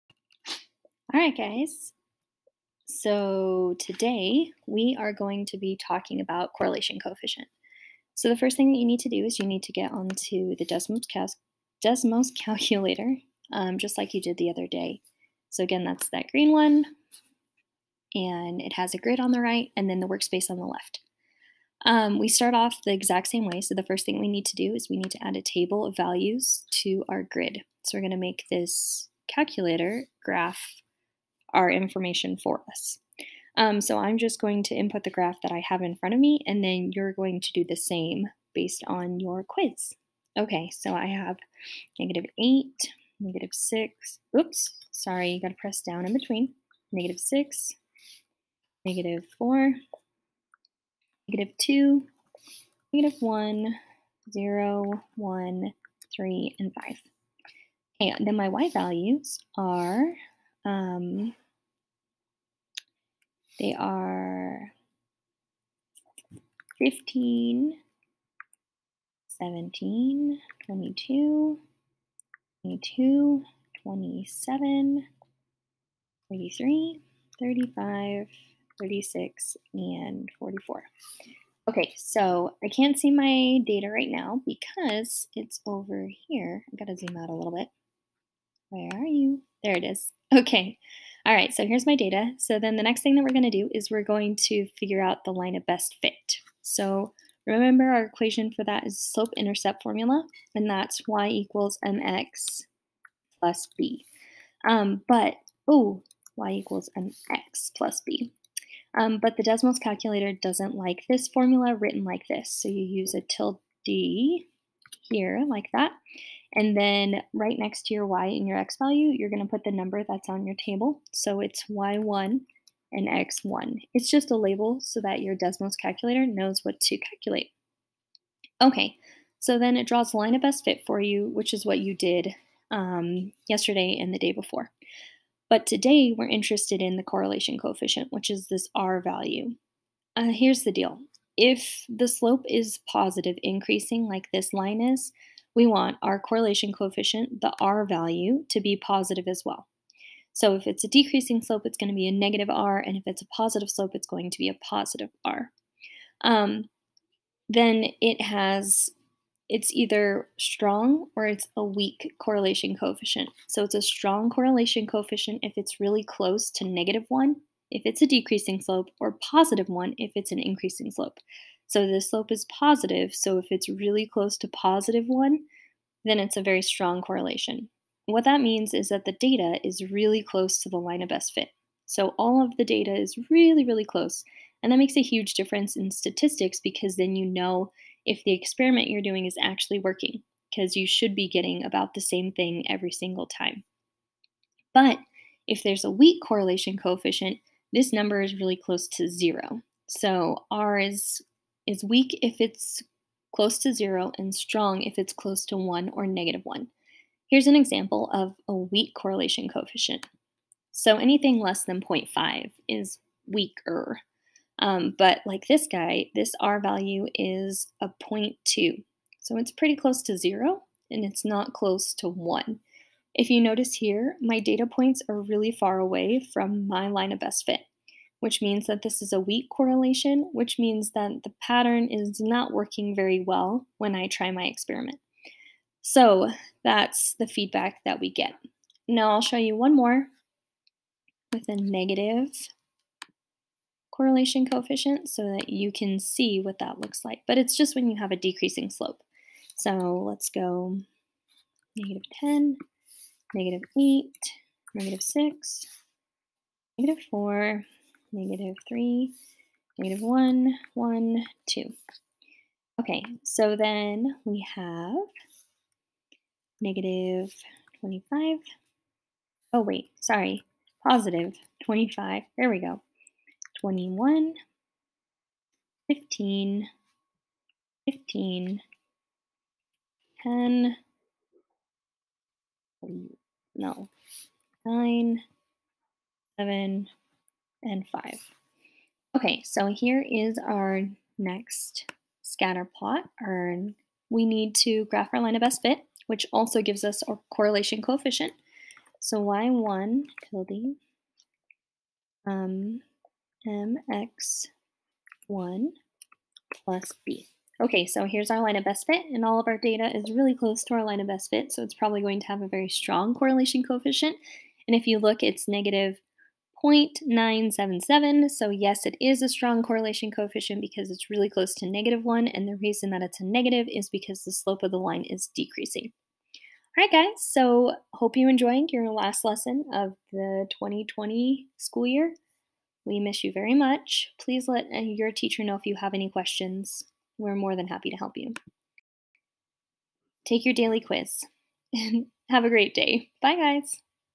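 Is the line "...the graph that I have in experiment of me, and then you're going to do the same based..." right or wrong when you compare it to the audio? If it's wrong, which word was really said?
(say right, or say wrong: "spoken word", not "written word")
wrong: "front", not "experiment".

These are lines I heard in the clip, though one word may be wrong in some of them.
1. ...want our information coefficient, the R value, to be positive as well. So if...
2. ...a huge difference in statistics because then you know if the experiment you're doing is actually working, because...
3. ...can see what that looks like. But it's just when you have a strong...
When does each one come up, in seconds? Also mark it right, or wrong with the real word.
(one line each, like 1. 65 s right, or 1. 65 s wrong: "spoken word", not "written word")
1. 145 s wrong: "correlation", not "information"
2. 184 s right
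3. 245 s wrong: "decreasing", not "strong".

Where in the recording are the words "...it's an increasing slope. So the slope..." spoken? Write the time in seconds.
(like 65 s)
170 s.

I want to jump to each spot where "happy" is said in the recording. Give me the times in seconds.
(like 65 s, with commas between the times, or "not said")
337 s.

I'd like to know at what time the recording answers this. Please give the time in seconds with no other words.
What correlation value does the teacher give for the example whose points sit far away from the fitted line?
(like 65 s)
218 s.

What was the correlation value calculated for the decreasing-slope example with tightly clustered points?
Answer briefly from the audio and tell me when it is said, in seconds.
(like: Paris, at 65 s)
-0.977, at 315 s.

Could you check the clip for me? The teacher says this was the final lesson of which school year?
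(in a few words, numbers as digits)
2020.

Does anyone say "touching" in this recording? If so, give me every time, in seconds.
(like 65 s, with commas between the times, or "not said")
not said.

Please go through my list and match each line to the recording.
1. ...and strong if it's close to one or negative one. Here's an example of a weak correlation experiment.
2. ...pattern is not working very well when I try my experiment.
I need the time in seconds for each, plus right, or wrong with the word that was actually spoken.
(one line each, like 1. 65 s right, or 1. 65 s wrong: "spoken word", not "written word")
1. 204 s wrong: "coefficient", not "experiment"
2. 231 s right.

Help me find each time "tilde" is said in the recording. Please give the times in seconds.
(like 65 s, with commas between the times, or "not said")
113 s, 300 s.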